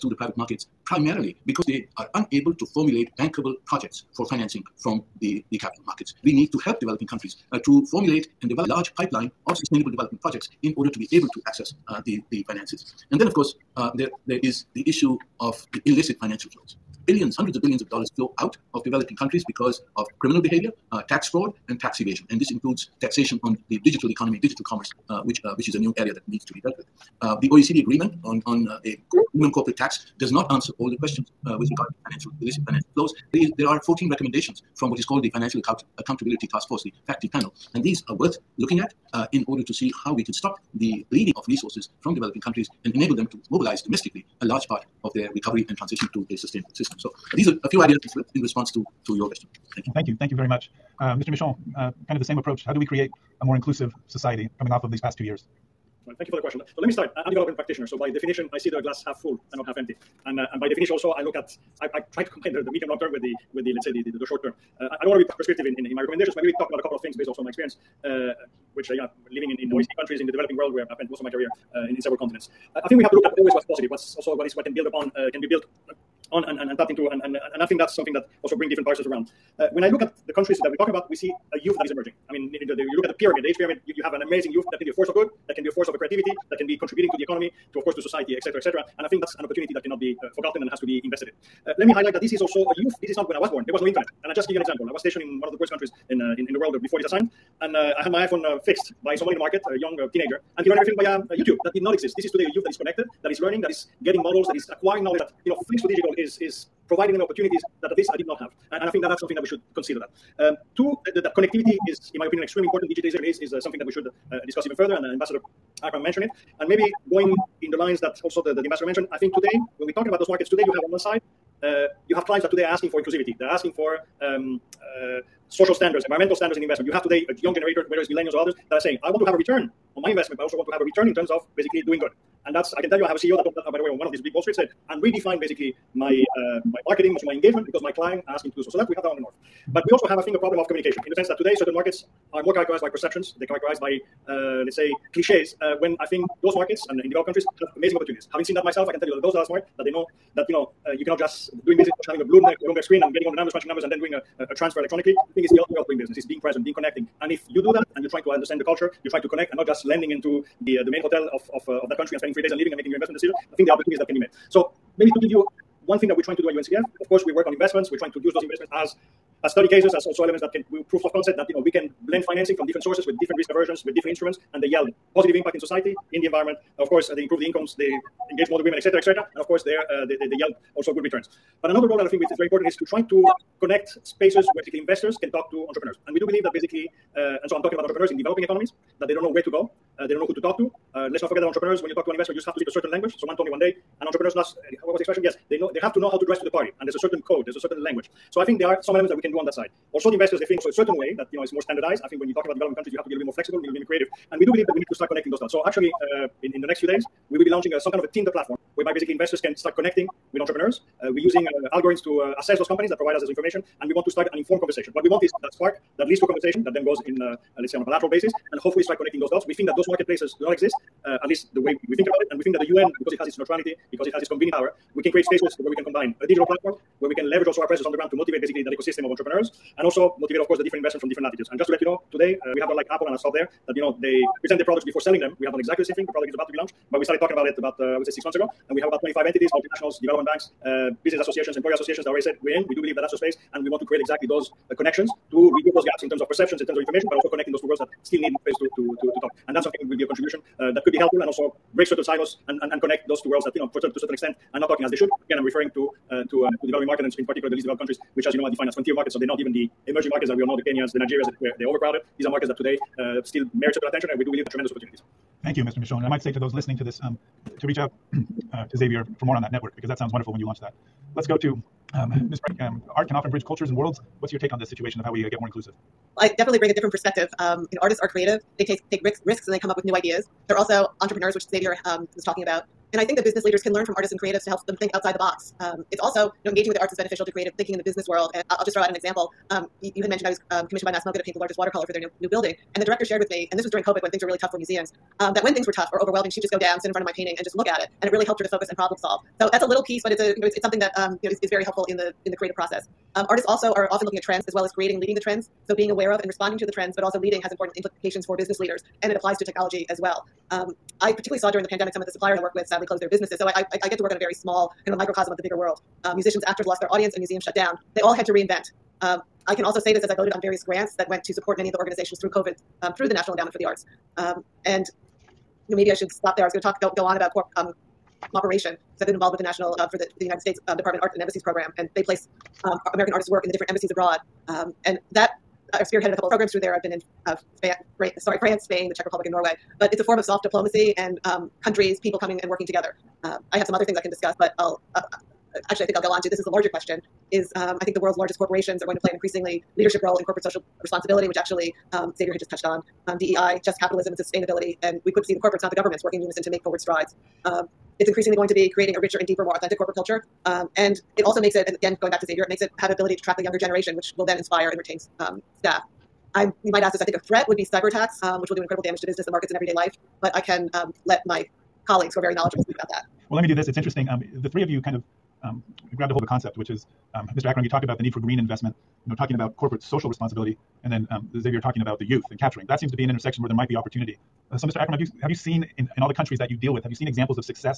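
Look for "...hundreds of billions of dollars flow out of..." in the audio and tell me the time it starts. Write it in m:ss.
0:17.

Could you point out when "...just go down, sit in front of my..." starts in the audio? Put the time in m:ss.
4:56.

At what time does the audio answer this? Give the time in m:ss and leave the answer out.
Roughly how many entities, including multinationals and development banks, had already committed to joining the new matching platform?
3:59.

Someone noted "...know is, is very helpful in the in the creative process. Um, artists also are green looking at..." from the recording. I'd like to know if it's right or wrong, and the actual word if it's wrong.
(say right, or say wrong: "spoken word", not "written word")
wrong: "often", not "green".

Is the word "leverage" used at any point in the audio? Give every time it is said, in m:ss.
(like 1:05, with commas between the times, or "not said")
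3:47.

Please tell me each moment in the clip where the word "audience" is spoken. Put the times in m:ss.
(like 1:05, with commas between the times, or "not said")
5:16.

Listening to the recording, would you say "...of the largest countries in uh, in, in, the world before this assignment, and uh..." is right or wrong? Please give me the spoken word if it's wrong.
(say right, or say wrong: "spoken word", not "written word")
wrong: "poorest", not "largest".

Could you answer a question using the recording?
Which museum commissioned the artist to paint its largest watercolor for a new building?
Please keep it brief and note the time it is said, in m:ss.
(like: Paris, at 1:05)
MASS MoCA, at 4:50.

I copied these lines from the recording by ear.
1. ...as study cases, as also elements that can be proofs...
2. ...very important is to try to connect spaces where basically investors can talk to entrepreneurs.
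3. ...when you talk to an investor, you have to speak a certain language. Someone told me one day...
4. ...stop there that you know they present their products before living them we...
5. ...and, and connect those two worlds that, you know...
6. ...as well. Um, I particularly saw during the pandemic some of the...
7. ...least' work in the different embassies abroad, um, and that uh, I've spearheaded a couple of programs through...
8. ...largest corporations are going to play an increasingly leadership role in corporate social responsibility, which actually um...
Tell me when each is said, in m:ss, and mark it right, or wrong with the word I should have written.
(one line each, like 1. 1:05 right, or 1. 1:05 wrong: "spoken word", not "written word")
1. 2:49 right
2. 3:02 right
3. 3:11 right
4. 3:53 wrong: "selling", not "living"
5. 4:12 right
6. 5:09 right
7. 5:33 wrong: "artists", not "least"
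8. 5:48 right.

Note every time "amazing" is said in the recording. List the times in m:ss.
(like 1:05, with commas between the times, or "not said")
1:24, 2:27.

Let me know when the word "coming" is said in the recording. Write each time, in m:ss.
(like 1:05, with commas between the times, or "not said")
0:54, 5:42.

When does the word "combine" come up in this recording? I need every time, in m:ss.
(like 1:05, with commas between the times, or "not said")
1:02, 3:45.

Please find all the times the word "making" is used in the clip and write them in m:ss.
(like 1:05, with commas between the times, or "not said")
2:42.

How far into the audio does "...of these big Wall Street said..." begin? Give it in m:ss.
2:14.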